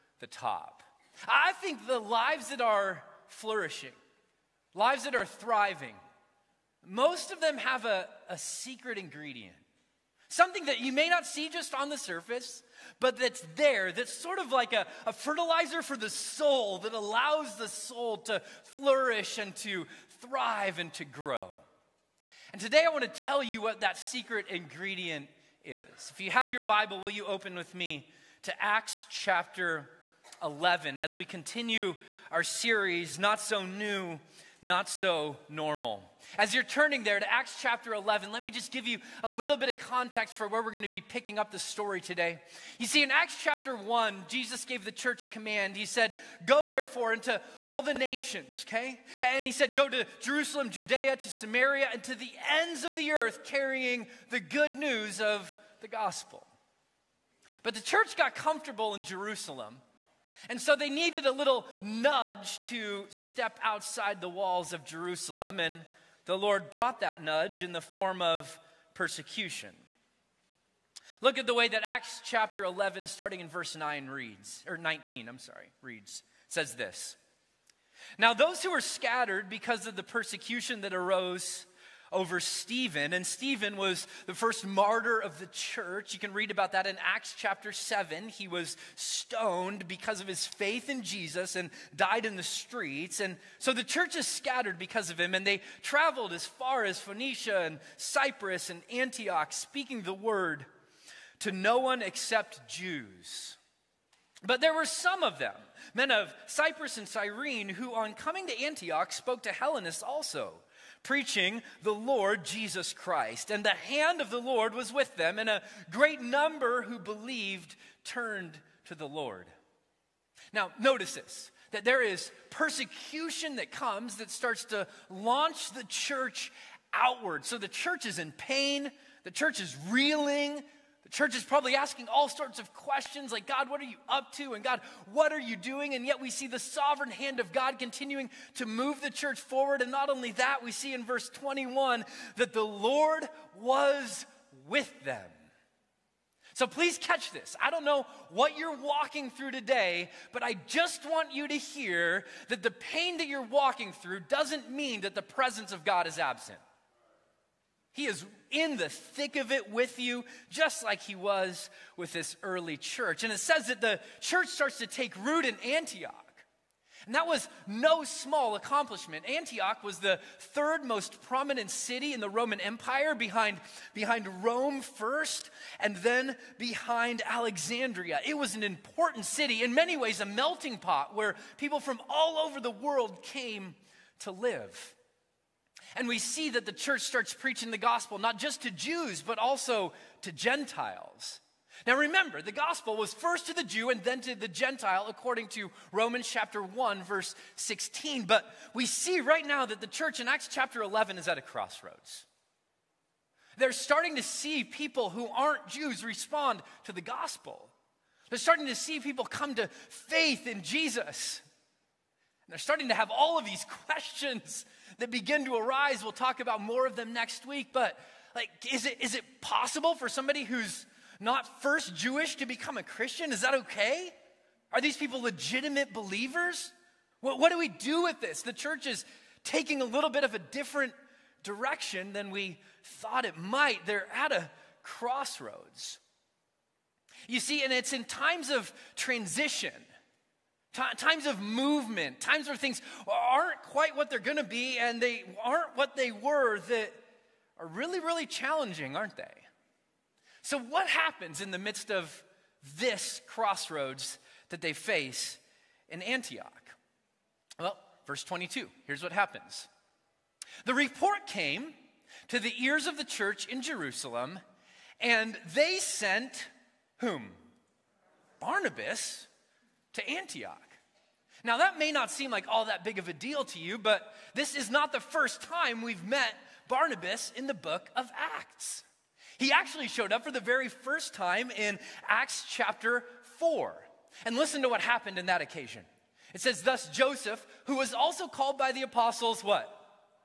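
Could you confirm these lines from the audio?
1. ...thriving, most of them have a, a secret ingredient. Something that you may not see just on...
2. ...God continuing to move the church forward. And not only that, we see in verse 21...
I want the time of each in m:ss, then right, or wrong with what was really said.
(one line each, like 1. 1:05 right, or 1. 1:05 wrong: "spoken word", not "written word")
1. 0:05 right
2. 2:17 right.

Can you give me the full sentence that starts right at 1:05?
And the Lord brought that nudge in the form of persecution.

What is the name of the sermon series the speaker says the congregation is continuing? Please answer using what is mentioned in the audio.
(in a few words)
Not So New, Not So Normal.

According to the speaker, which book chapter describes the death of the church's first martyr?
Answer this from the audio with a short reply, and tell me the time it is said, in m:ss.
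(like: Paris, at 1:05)
Acts chapter 7, at 1:27.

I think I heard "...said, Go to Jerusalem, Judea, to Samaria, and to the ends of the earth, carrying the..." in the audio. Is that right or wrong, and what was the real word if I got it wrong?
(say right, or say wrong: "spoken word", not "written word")
right.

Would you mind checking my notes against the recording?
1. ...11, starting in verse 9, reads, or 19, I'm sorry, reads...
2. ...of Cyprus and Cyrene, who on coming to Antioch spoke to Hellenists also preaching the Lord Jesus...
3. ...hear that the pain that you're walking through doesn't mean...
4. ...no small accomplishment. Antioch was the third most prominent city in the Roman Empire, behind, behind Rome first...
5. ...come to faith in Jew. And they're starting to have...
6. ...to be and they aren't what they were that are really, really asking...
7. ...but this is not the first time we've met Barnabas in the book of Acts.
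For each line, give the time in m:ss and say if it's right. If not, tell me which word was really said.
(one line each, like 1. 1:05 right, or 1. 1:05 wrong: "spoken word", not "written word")
1. 1:12 right
2. 1:46 right
3. 2:31 right
4. 2:47 right
5. 3:29 wrong: "Jesus", not "Jew"
6. 4:04 wrong: "challenging", not "asking"
7. 4:33 right.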